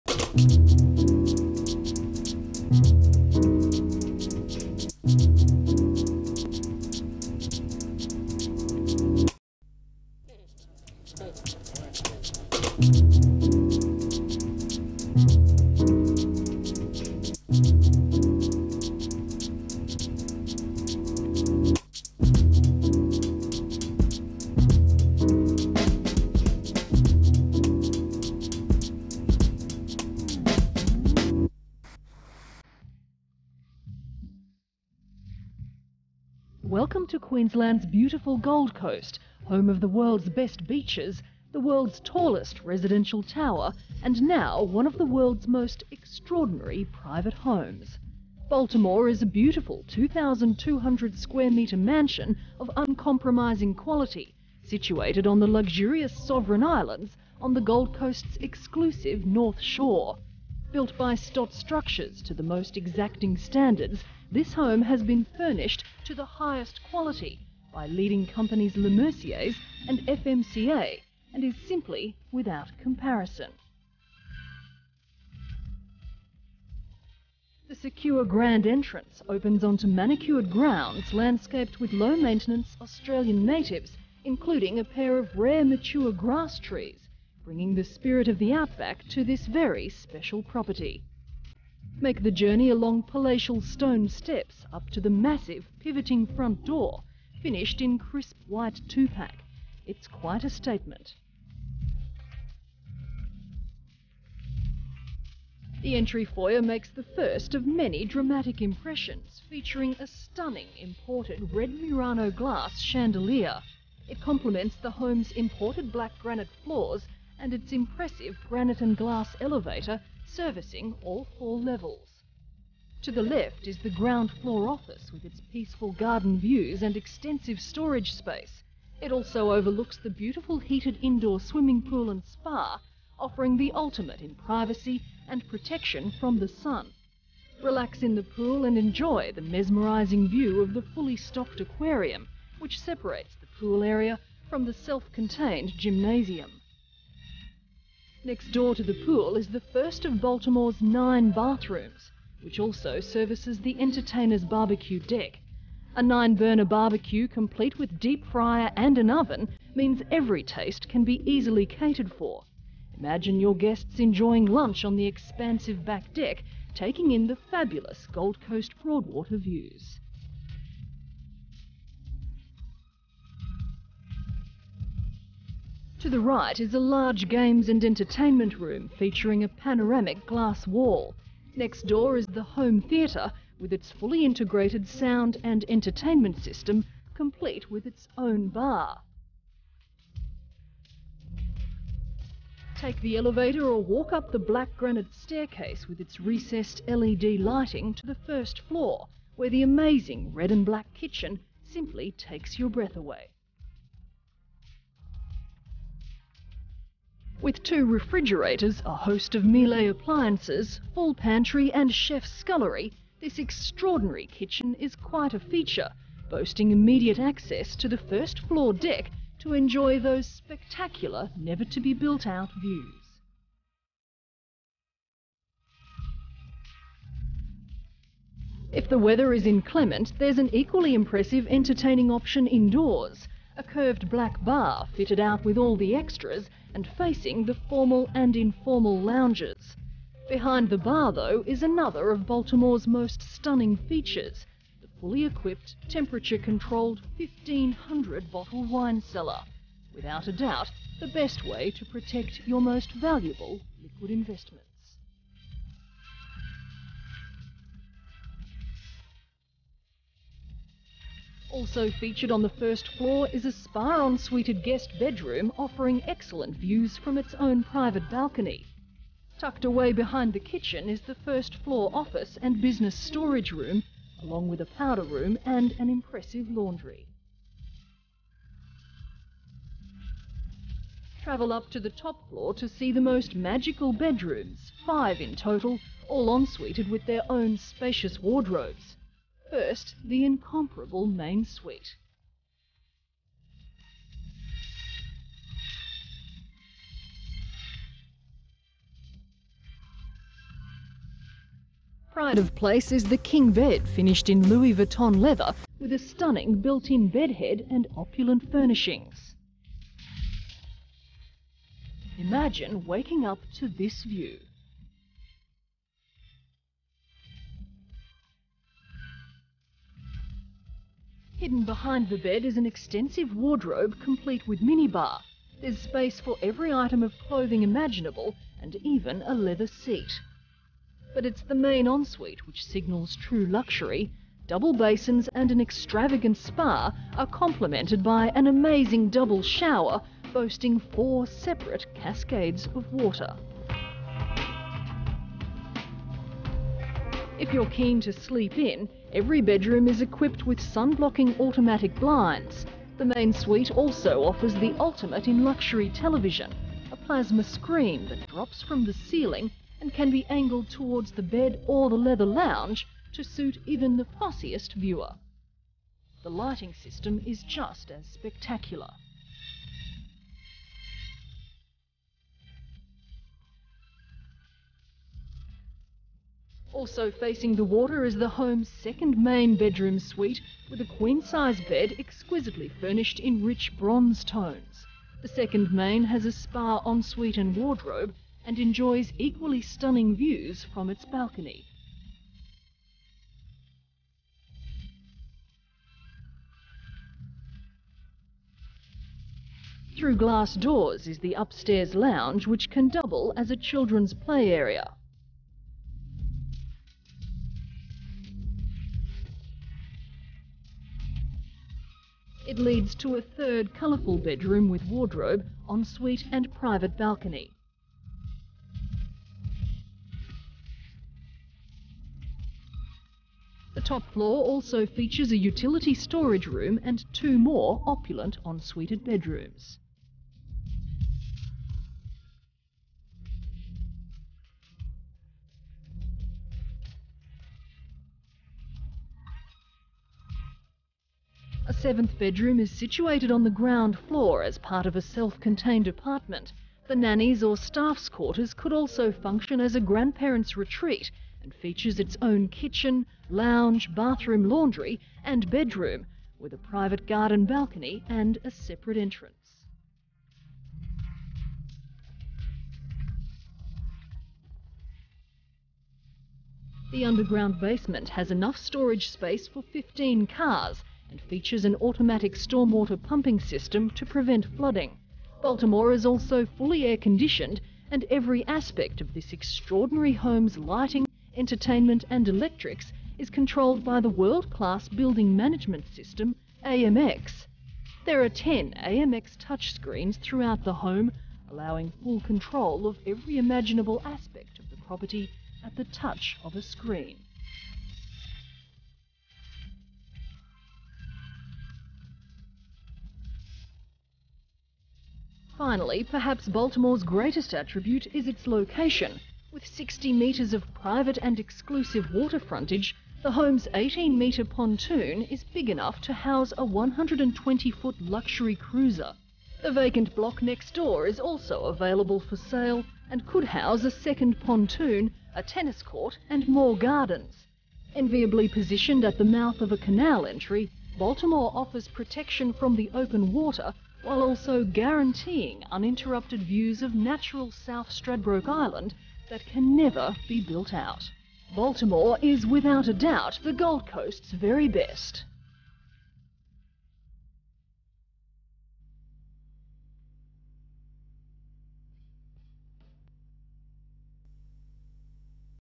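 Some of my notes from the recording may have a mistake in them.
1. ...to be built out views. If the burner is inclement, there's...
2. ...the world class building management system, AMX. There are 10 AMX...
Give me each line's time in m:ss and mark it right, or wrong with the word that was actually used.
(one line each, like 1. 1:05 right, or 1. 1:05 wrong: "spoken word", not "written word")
1. 3:41 wrong: "weather", not "burner"
2. 8:03 right.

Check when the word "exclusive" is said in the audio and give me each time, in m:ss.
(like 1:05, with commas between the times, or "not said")
0:58, 8:31.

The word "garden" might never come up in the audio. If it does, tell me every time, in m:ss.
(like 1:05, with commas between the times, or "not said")
2:05, 7:37, 8:46.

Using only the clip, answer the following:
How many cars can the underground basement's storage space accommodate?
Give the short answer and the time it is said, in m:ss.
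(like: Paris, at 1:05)
15, at 7:49.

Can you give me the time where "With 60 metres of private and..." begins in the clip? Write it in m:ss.
8:29.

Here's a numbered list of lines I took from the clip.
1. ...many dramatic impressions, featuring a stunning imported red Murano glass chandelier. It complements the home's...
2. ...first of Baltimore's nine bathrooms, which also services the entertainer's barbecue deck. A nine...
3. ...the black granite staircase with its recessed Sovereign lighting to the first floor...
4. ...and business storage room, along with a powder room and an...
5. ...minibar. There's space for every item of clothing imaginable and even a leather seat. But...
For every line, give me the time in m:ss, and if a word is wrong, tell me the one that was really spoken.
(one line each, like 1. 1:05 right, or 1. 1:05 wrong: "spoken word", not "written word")
1. 1:47 right
2. 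2:29 right
3. 3:14 wrong: "LED", not "Sovereign"
4. 4:32 right
5. 5:24 right.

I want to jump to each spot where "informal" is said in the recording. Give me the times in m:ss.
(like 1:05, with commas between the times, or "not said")
3:58.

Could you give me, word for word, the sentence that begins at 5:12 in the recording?
Imagine waking up to this view.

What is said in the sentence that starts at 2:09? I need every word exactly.
It also overlooks the beautiful heated indoor swimming pool and spa, offering the ultimate in privacy and protection from the sun.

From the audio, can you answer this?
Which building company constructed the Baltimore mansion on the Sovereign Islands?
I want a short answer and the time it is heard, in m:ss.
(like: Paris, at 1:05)
Stott Structures, at 1:01.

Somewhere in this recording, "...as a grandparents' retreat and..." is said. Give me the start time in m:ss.
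7:29.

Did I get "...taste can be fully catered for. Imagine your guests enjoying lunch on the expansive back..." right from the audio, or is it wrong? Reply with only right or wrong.
wrong.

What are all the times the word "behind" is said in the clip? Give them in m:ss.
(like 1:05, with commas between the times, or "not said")
4:00, 4:29, 5:21.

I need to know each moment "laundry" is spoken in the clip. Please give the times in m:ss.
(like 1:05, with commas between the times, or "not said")
4:36, 7:34.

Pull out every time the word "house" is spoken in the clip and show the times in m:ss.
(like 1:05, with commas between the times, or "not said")
8:36, 8:43.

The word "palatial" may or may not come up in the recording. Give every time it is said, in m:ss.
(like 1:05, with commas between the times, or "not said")
1:33.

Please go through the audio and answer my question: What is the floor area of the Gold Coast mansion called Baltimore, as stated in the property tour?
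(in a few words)
2,200 square metres.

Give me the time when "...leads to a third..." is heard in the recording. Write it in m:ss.
6:52.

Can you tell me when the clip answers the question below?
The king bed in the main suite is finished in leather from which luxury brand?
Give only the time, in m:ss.
5:04.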